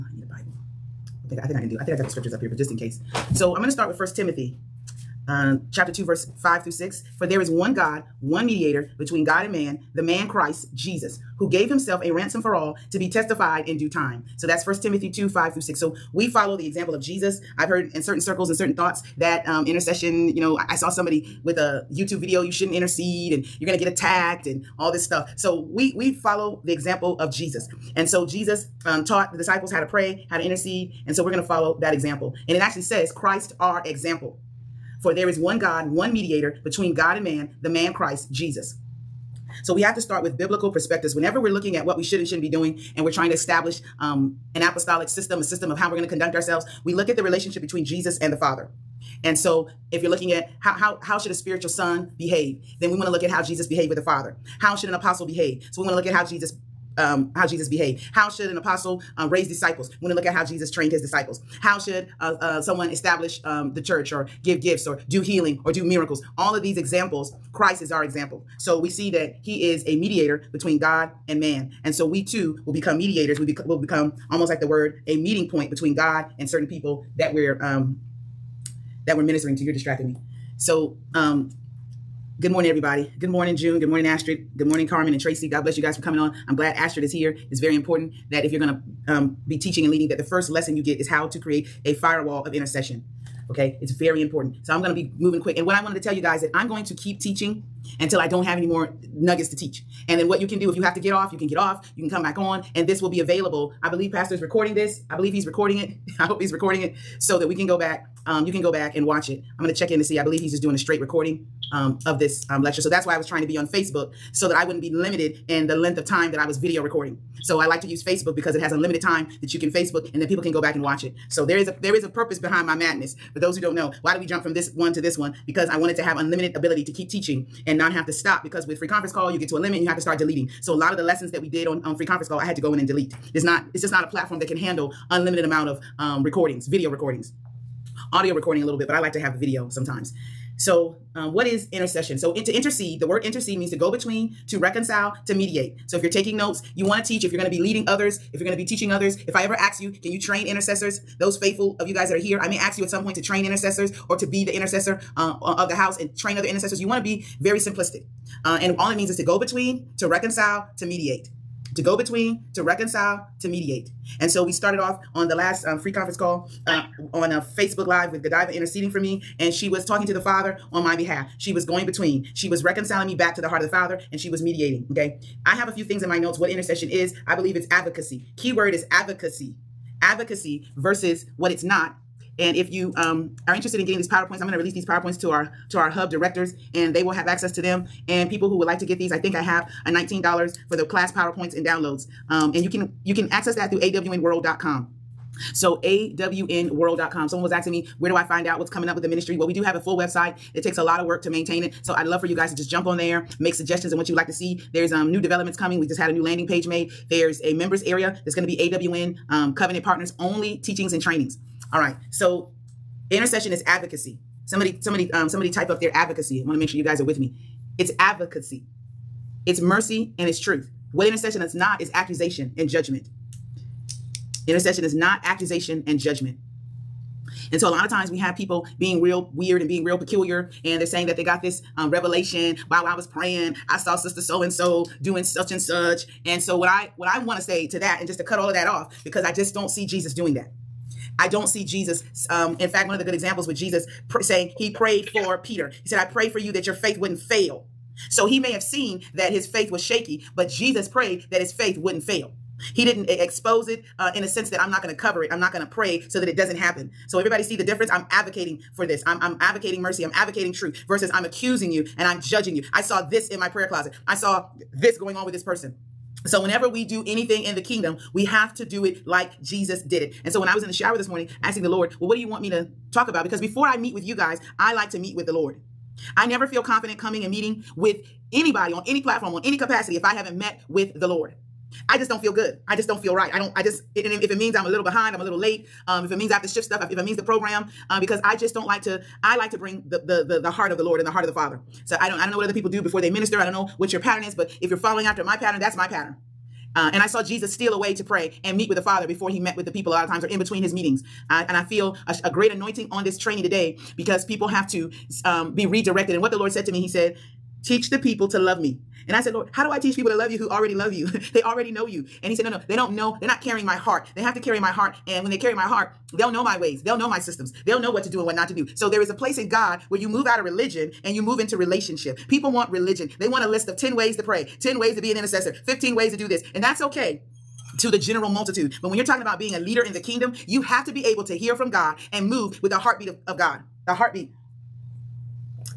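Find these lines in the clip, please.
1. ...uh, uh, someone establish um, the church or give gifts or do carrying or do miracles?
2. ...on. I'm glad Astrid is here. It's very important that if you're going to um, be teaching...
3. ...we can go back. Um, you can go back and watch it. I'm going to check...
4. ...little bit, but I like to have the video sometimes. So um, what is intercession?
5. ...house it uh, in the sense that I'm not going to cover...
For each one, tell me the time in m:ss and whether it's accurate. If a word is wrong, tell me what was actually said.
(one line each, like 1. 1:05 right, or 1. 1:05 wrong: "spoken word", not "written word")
1. 1:02 wrong: "healing", not "carrying"
2. 1:26 right
3. 1:47 right
4. 2:18 right
5. 4:13 wrong: "expose", not "house".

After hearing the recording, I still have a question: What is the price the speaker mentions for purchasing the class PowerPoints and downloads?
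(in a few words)
$19.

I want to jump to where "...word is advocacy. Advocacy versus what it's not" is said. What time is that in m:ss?
2:58.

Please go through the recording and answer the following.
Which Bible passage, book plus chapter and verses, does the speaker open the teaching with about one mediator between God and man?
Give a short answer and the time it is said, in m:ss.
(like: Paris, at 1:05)
1 Timothy 2:5-6, at 0:03.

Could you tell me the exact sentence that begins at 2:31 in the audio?
those faithful of you guys that are here.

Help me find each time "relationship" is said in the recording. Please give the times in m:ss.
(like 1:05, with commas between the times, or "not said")
0:47, 5:21.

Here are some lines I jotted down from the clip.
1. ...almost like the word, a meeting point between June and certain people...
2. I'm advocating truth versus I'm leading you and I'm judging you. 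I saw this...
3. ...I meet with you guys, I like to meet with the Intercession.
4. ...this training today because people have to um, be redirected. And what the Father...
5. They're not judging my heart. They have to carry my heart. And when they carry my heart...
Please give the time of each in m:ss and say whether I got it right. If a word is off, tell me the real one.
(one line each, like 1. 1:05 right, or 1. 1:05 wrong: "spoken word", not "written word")
1. 1:14 wrong: "God", not "June"
2. 4:20 wrong: "accusing", not "leading"
3. 4:33 wrong: "Lord", not "Intercession"
4. 5:03 wrong: "Lord", not "Father"
5. 5:13 wrong: "carrying", not "judging".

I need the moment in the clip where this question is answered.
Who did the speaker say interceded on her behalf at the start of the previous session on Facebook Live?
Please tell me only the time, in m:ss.
2:48.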